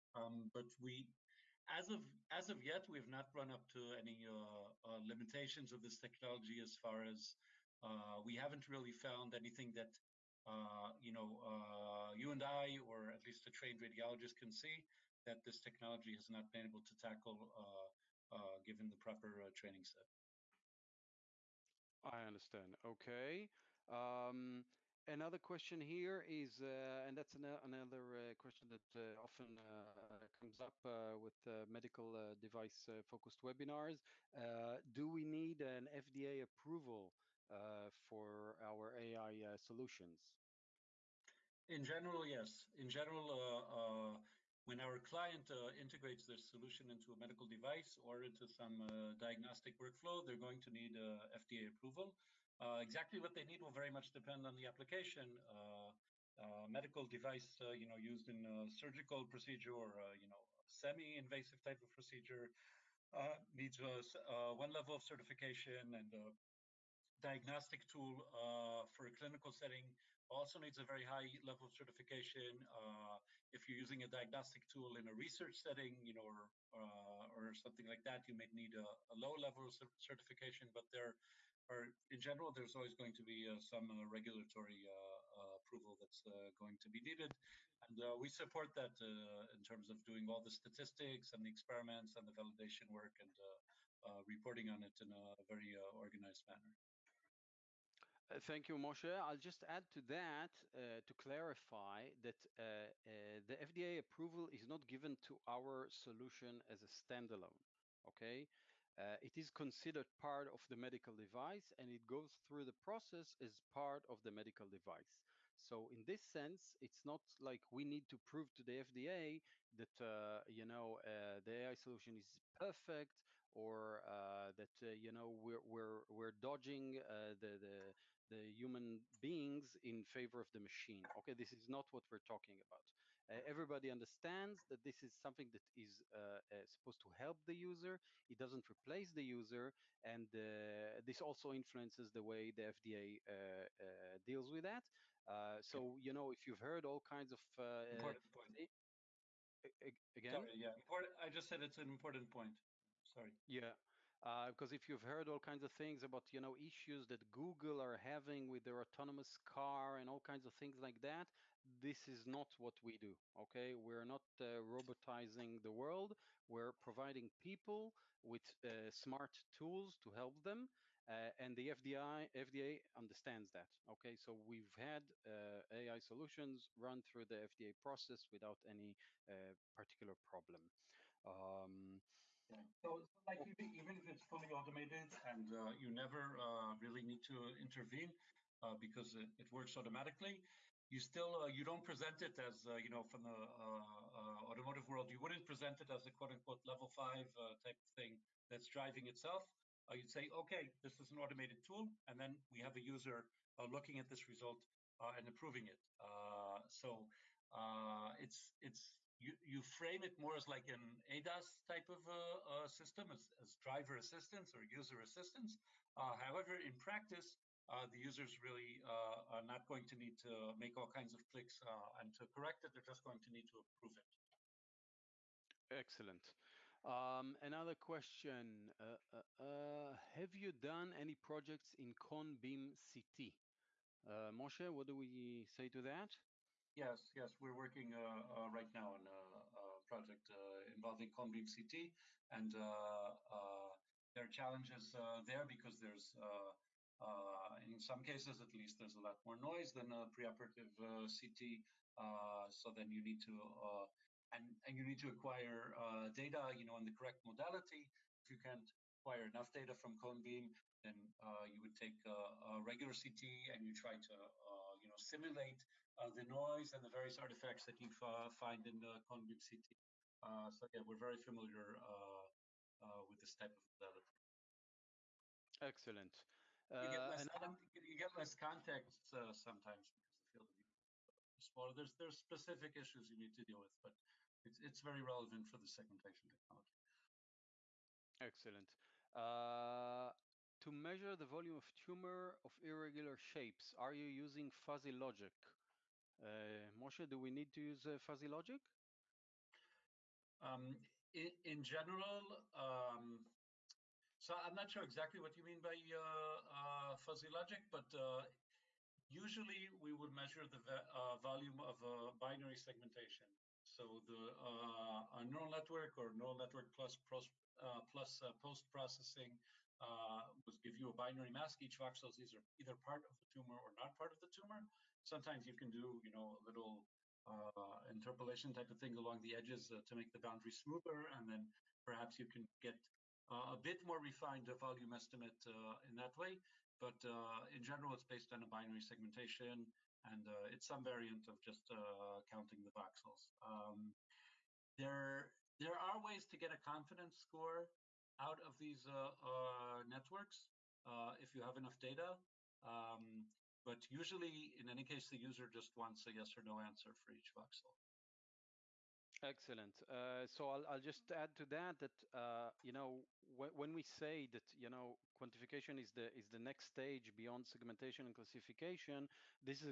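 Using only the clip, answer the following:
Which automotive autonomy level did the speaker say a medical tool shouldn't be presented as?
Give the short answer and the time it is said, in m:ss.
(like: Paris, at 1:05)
level five, at 3:16.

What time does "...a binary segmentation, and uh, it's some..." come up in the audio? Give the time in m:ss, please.
5:38.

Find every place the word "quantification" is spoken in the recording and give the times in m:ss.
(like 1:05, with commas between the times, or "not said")
6:05.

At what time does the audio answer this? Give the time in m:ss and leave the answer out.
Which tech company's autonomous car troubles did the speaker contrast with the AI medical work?
2:37.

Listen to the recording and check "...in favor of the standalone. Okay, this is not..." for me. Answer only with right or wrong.
wrong.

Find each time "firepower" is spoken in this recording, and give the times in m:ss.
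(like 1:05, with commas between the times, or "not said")
not said.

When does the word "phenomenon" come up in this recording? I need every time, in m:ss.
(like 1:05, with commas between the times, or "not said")
not said.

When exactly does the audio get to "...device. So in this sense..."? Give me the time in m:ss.
1:54.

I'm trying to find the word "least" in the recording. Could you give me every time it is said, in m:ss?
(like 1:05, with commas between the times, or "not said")
0:13, 4:08.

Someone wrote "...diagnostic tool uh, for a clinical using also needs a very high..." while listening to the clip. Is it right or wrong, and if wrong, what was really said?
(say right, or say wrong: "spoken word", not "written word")
wrong: "setting", not "using".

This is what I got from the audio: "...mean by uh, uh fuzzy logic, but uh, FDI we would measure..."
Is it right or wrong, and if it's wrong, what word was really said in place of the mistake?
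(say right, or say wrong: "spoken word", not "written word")
wrong: "Usually", not "FDI".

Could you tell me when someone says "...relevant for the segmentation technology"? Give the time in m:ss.
4:45.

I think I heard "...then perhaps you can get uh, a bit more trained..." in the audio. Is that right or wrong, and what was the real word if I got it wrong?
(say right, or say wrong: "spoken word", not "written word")
wrong: "refined", not "trained".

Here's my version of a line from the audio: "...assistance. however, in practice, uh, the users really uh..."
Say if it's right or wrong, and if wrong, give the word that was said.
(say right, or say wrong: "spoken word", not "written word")
right.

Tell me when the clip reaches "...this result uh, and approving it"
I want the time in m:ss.
3:24.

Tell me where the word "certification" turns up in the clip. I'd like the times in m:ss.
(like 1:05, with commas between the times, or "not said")
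1:05, 1:11, 1:19.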